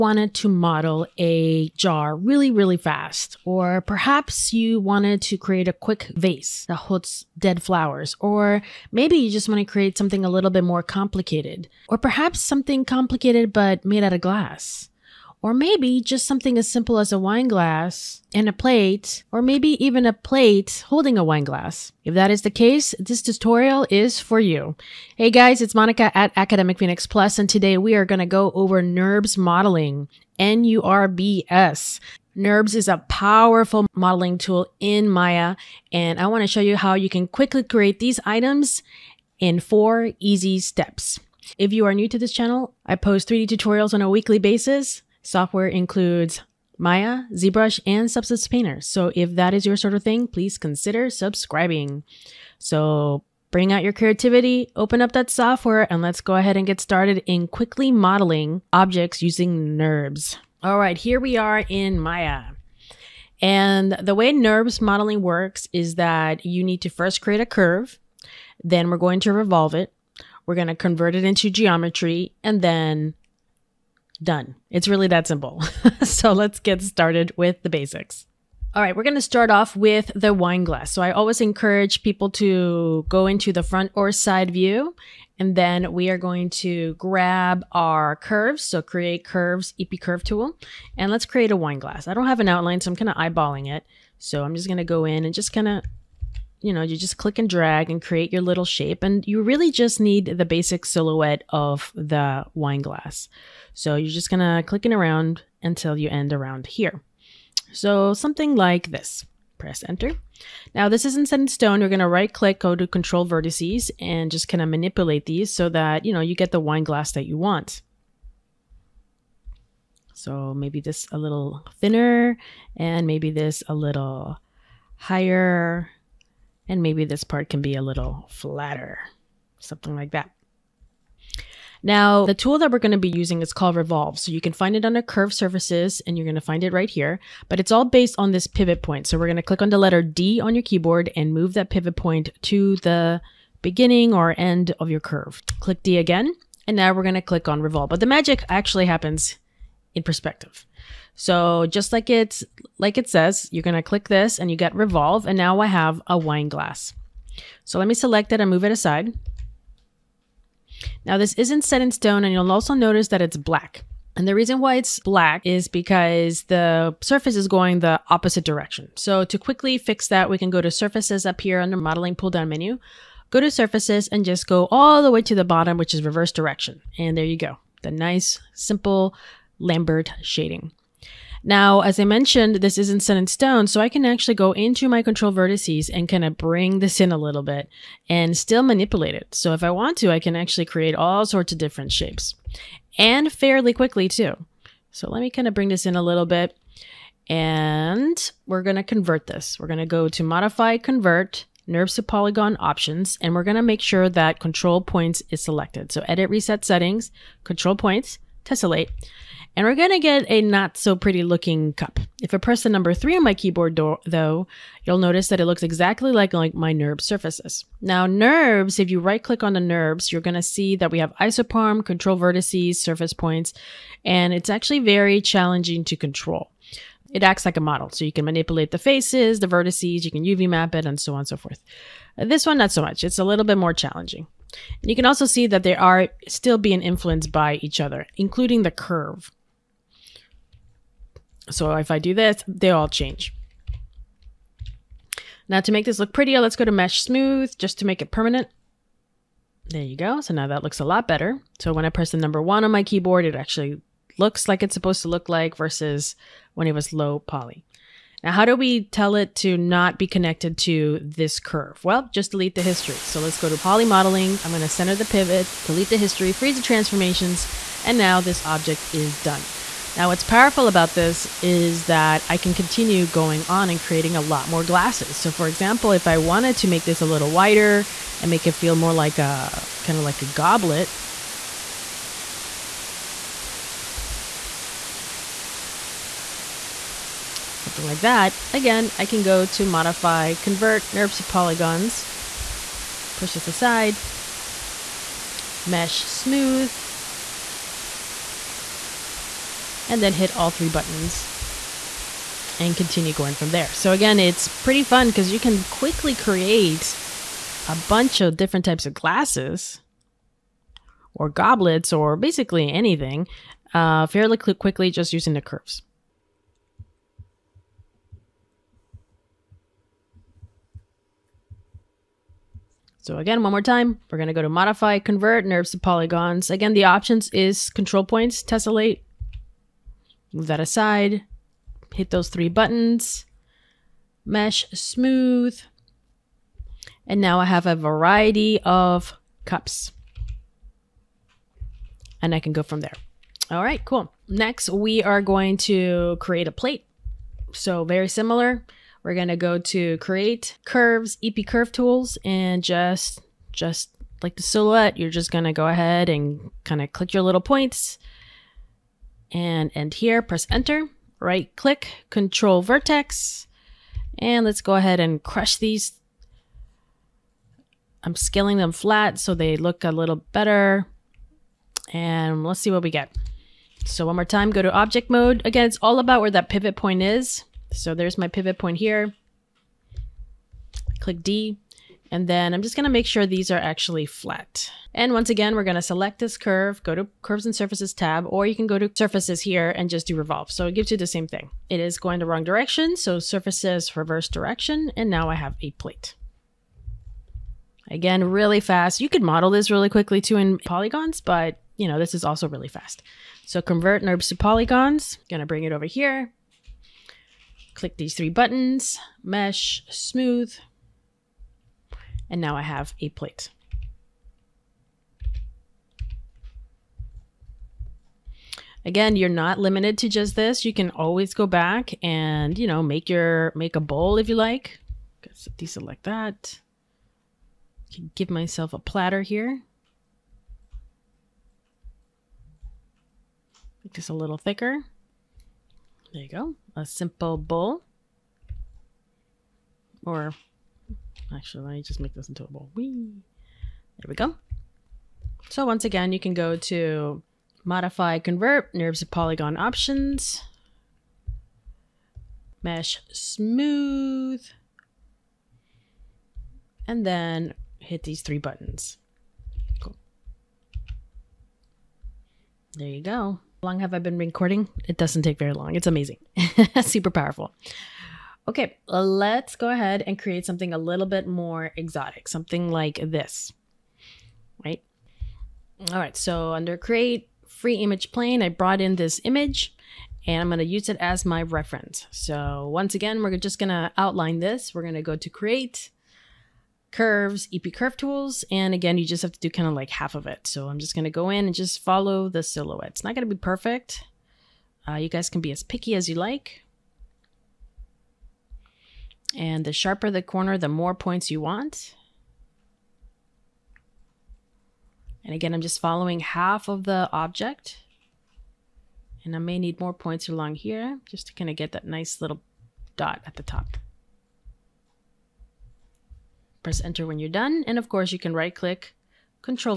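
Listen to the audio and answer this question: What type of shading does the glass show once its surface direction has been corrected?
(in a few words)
Lambert.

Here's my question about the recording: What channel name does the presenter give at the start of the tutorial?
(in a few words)
Academic Phoenix Plus.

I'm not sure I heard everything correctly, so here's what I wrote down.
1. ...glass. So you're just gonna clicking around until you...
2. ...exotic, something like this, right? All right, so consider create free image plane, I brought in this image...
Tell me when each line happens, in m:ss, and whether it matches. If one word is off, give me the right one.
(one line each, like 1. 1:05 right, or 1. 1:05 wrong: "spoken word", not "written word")
1. 1:42 right
2. 7:51 wrong: "under", not "consider".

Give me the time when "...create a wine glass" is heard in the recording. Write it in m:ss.
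1:31.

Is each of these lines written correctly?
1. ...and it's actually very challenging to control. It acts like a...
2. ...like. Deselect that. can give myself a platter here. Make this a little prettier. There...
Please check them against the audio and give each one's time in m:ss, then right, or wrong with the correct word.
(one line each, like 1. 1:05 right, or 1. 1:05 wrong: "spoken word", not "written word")
1. 3:44 right
2. 7:04 wrong: "thicker", not "prettier".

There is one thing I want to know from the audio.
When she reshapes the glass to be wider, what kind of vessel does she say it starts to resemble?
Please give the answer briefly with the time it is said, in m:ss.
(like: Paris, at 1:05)
A goblet, at 4:40.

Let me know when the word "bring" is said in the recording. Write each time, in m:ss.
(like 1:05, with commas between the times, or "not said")
0:53, 3:06, 3:15, 6:45.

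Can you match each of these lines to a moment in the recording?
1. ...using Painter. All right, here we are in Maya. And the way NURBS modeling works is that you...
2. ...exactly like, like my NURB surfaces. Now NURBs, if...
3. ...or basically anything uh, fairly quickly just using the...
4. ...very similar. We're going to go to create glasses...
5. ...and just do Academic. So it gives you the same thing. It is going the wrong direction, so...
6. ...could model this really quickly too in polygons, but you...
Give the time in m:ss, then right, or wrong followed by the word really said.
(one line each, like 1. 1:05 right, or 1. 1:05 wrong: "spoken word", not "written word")
1. 0:59 wrong: "NURBS", not "Painter"
2. 3:35 right
3. 5:11 right
4. 5:47 wrong: "curves", not "glasses"
5. 6:29 wrong: "Revolve", not "Academic"
6. 6:39 right.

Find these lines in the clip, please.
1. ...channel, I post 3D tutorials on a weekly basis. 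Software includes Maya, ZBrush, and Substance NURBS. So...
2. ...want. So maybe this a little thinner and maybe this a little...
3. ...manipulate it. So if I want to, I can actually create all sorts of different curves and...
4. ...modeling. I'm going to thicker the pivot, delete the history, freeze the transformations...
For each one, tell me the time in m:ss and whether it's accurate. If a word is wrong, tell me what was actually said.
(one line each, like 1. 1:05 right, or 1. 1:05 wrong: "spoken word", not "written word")
1. 0:42 wrong: "Painter", not "NURBS"
2. 1:57 right
3. 3:08 wrong: "shapes", not "curves"
4. 4:23 wrong: "center", not "thicker".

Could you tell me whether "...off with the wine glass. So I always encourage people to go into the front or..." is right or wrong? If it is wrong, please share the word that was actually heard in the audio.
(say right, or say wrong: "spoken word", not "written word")
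right.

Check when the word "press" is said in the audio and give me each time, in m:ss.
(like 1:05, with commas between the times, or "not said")
1:49, 3:32, 4:11, 6:00, 8:36.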